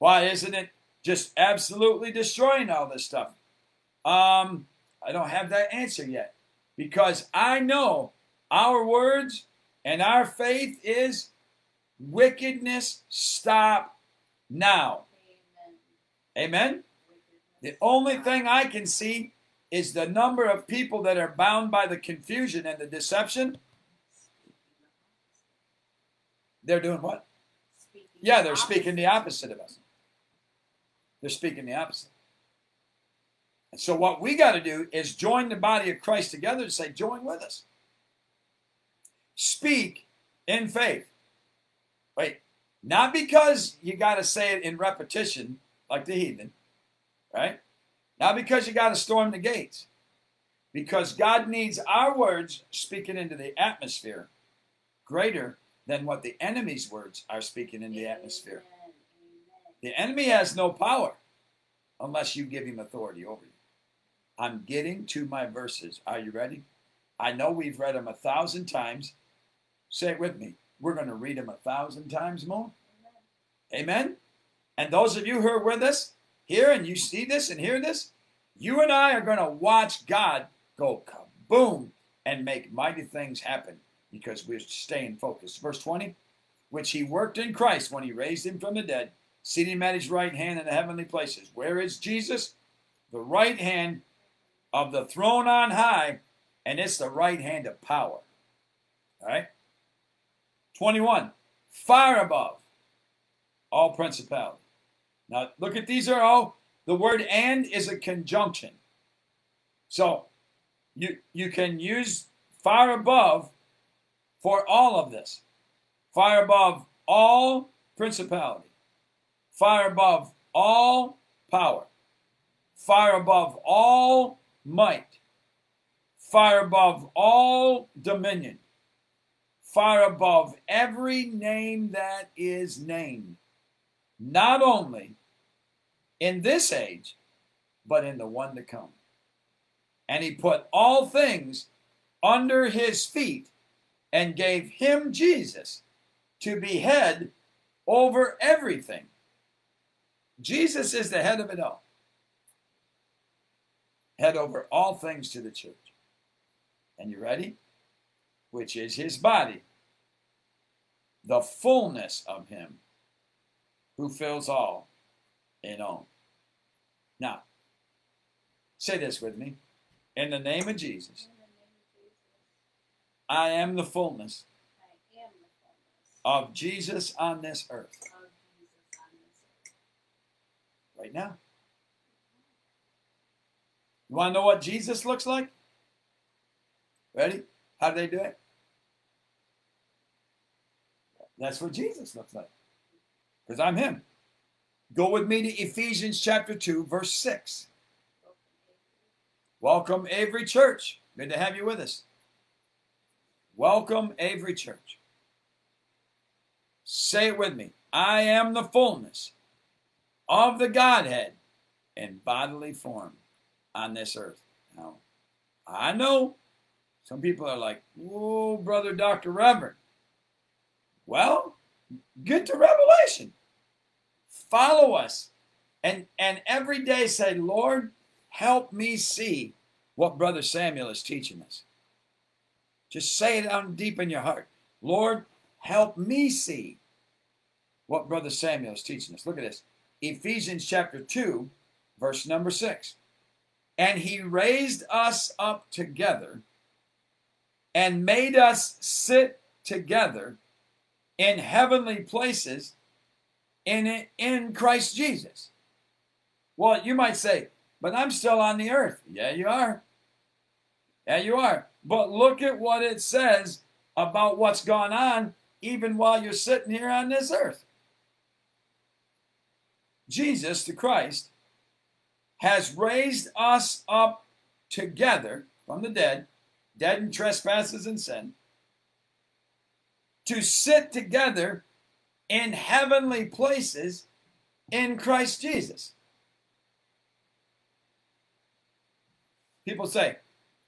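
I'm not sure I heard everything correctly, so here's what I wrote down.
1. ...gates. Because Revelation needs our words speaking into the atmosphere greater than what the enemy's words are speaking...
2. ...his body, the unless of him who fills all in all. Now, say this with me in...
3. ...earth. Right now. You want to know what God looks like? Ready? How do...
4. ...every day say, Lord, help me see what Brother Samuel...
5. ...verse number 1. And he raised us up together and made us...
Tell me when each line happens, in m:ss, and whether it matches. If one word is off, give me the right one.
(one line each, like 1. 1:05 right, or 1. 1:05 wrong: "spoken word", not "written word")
1. 0:49 wrong: "God", not "Revelation"
2. 2:38 wrong: "fullness", not "unless"
3. 2:57 wrong: "Jesus", not "God"
4. 3:46 right
5. 4:01 wrong: "6", not "1".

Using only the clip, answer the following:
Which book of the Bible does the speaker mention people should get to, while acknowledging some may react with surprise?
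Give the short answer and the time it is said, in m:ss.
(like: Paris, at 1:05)
Revelation, at 3:42.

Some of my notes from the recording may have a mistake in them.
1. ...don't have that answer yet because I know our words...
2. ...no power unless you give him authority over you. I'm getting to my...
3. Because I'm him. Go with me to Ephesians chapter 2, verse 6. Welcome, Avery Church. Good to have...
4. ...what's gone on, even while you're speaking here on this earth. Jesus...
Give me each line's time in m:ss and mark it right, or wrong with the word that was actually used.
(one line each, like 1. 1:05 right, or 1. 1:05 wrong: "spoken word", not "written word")
1. 0:05 right
2. 1:00 right
3. 3:13 right
4. 4:24 wrong: "sitting", not "speaking".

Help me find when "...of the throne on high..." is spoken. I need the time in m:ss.
1:34.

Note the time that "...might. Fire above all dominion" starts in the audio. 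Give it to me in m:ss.
2:04.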